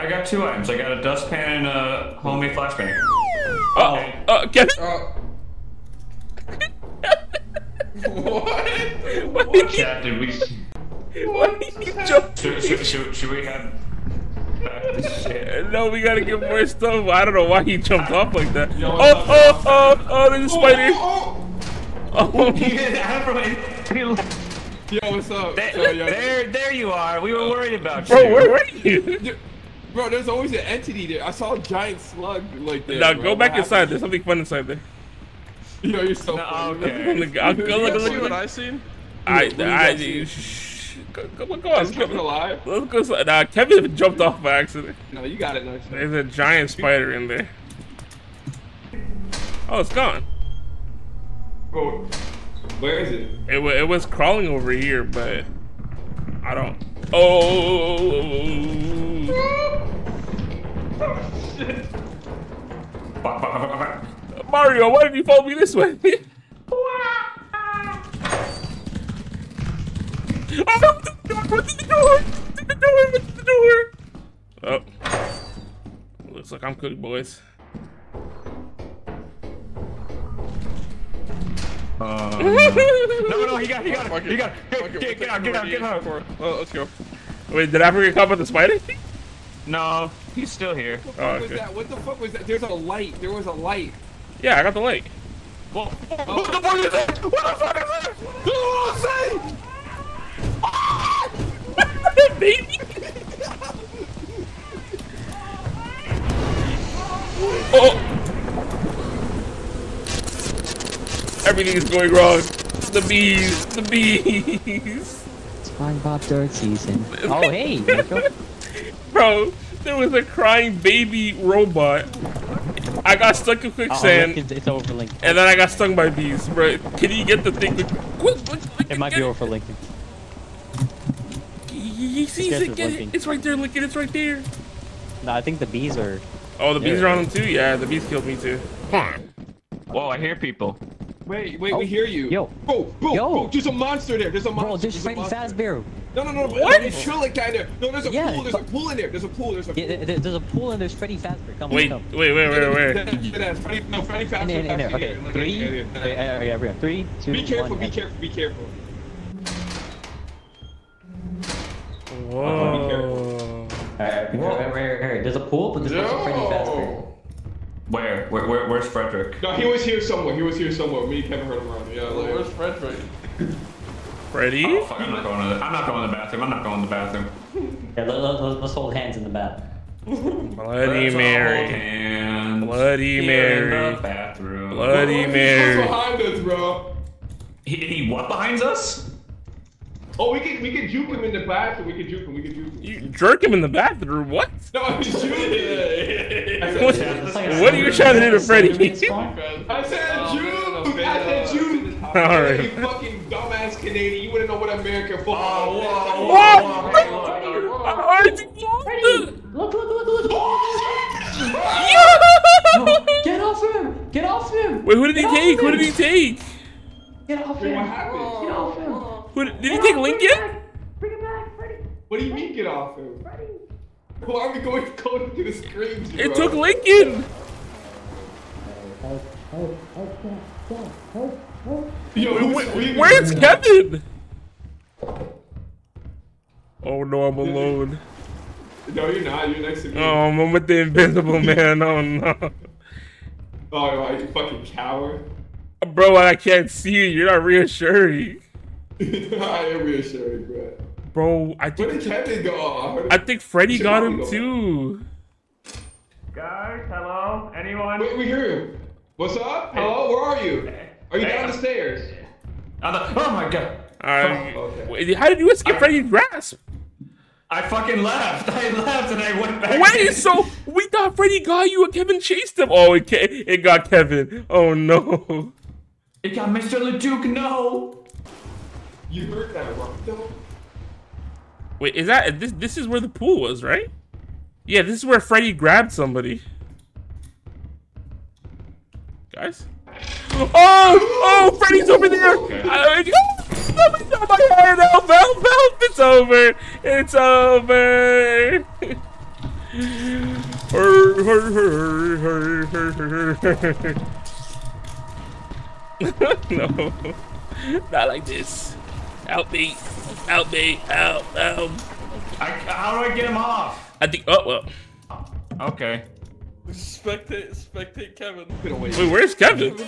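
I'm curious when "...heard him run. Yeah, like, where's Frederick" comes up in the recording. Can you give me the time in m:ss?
2:51.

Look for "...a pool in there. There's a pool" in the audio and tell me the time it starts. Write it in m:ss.
2:28.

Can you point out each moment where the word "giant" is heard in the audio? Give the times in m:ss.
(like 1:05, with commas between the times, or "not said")
0:31, 0:46.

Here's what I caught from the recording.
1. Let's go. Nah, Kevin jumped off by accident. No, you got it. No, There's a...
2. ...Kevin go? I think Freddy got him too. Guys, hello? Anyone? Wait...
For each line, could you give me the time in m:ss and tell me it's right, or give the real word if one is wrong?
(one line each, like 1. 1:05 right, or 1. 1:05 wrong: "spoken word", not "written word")
1. 0:42 right
2. 4:12 right.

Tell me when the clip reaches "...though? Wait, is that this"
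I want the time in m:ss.
4:40.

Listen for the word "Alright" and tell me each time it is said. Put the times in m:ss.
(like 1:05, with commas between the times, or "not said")
2:43.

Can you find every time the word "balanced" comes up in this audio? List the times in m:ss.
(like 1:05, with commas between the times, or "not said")
not said.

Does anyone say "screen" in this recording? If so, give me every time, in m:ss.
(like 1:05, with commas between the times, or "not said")
3:45.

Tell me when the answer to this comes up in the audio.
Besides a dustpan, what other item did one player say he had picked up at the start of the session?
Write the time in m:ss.
0:02.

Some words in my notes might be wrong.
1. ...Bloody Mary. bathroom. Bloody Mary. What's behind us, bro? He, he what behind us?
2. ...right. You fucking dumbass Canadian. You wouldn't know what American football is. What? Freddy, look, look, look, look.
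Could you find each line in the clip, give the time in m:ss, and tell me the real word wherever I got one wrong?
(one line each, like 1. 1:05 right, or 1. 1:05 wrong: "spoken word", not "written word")
1. 3:02 right
2. 3:22 right.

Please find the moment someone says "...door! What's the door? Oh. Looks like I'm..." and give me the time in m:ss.
1:12.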